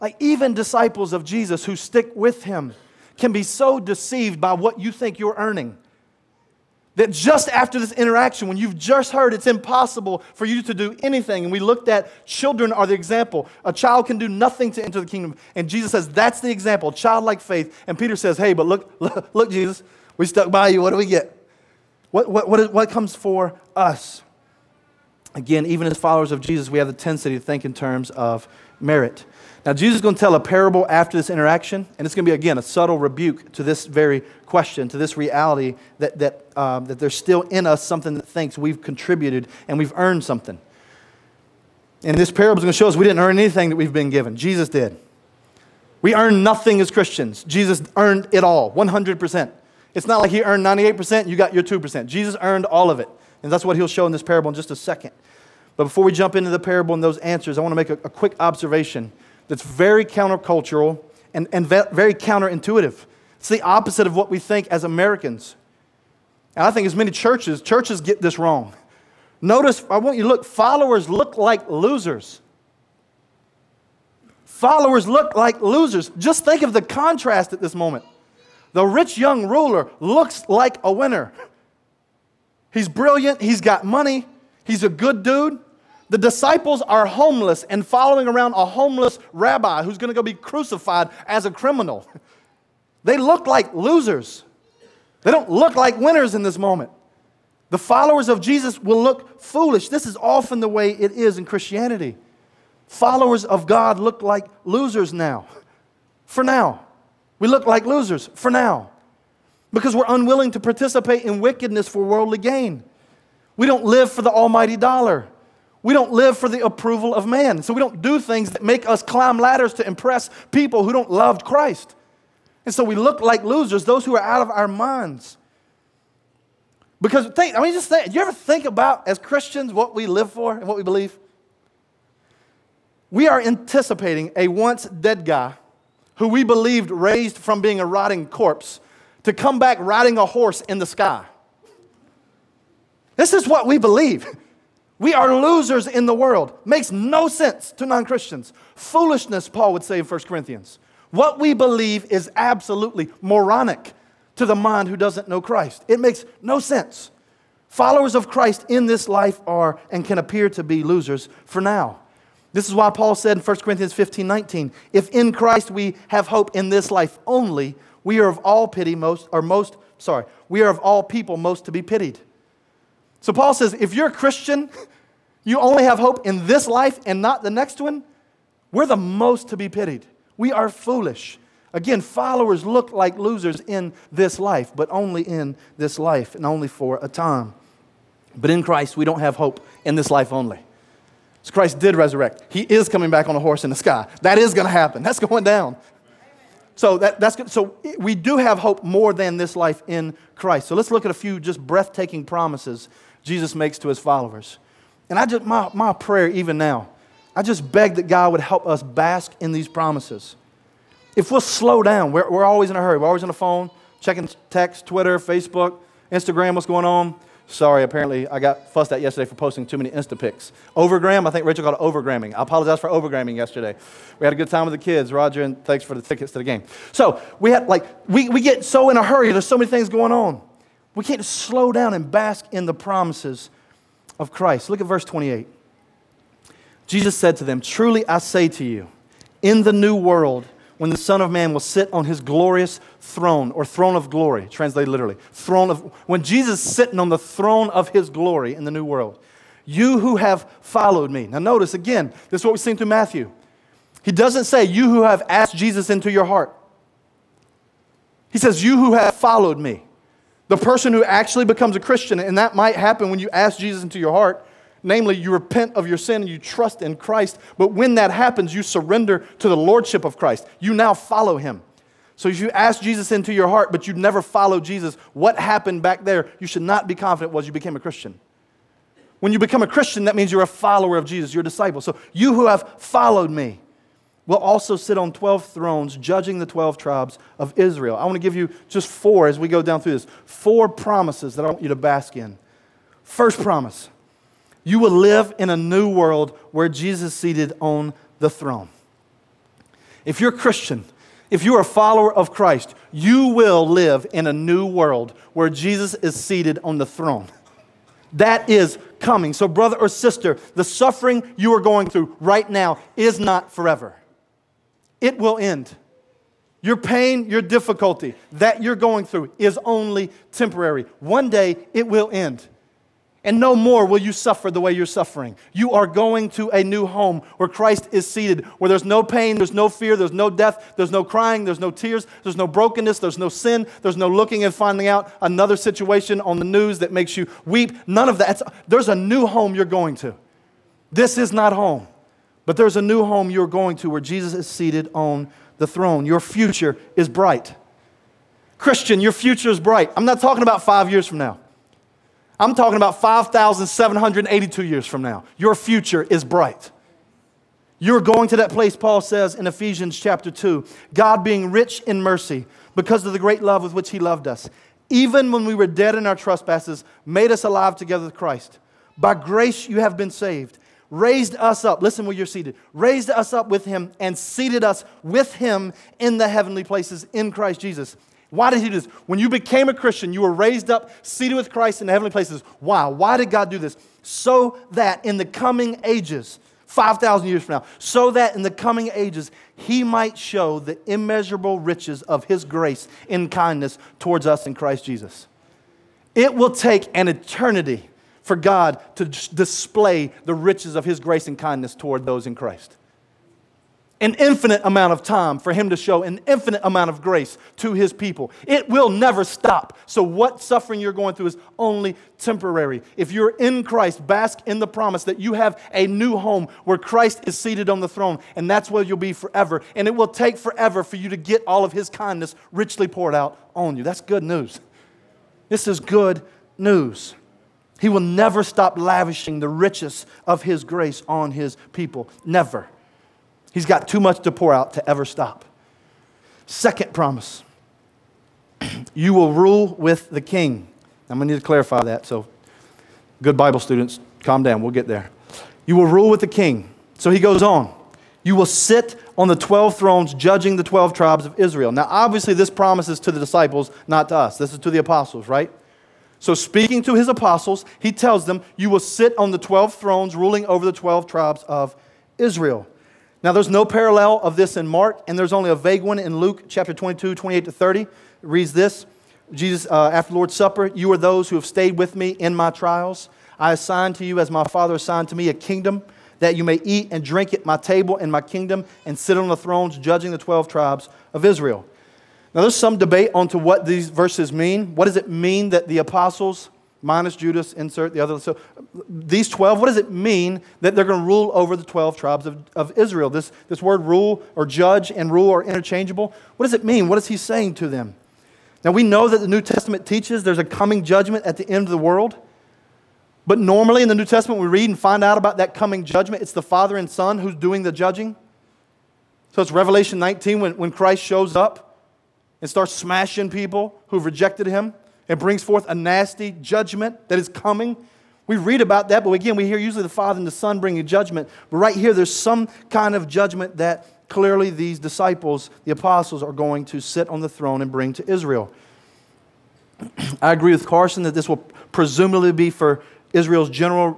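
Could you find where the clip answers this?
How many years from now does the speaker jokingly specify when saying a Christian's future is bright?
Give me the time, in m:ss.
5:52.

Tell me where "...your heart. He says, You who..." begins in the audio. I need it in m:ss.
4:16.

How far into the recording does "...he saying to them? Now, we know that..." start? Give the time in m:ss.
8:17.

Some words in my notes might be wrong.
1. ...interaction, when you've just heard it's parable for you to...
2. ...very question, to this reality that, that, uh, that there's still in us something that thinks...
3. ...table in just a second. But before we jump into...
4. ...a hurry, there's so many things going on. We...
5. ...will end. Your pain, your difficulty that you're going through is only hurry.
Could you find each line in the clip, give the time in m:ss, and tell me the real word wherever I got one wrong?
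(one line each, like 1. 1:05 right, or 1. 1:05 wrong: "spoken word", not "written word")
1. 0:07 wrong: "impossible", not "parable"
2. 0:33 right
3. 0:54 wrong: "parable", not "table"
4. 3:48 right
5. 5:15 wrong: "temporary", not "hurry".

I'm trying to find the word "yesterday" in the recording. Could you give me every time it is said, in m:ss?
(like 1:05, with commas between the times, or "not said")
3:39, 3:43.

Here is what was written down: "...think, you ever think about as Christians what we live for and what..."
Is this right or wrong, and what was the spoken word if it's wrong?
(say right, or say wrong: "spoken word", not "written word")
right.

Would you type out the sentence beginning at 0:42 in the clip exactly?
And this parable is going to show us we didn't earn anything that we've been given, Jesus did.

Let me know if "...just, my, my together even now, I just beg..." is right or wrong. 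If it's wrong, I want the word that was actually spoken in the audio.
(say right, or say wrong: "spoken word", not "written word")
wrong: "prayer", not "together".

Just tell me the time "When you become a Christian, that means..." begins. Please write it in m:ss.
4:39.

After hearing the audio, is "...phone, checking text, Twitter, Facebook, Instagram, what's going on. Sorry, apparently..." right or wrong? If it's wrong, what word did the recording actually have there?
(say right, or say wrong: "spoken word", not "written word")
right.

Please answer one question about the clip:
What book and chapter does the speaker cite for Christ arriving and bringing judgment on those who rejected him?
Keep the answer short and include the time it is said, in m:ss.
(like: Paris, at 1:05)
Revelation 19, at 8:29.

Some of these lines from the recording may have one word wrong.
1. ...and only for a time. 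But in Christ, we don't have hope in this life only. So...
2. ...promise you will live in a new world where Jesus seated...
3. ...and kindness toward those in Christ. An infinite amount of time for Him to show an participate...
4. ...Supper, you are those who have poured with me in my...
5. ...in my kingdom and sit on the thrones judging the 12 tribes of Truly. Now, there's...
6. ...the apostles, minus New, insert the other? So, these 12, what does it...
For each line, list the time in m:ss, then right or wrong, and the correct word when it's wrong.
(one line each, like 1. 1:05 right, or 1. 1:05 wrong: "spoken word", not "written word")
1. 3:06 right
2. 4:53 right
3. 6:41 wrong: "infinite", not "participate"
4. 7:50 wrong: "stayed", not "poured"
5. 7:57 wrong: "Israel", not "Truly"
6. 8:05 wrong: "Judas", not "New".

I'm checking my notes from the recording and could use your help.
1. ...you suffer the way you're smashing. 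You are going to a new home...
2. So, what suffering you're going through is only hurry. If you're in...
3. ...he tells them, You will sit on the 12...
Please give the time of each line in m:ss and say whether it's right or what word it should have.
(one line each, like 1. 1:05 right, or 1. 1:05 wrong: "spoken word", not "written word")
1. 5:23 wrong: "suffering", not "smashing"
2. 6:49 wrong: "temporary", not "hurry"
3. 7:37 right.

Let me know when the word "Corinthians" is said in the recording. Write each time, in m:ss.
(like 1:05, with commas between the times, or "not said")
2:30, 2:43.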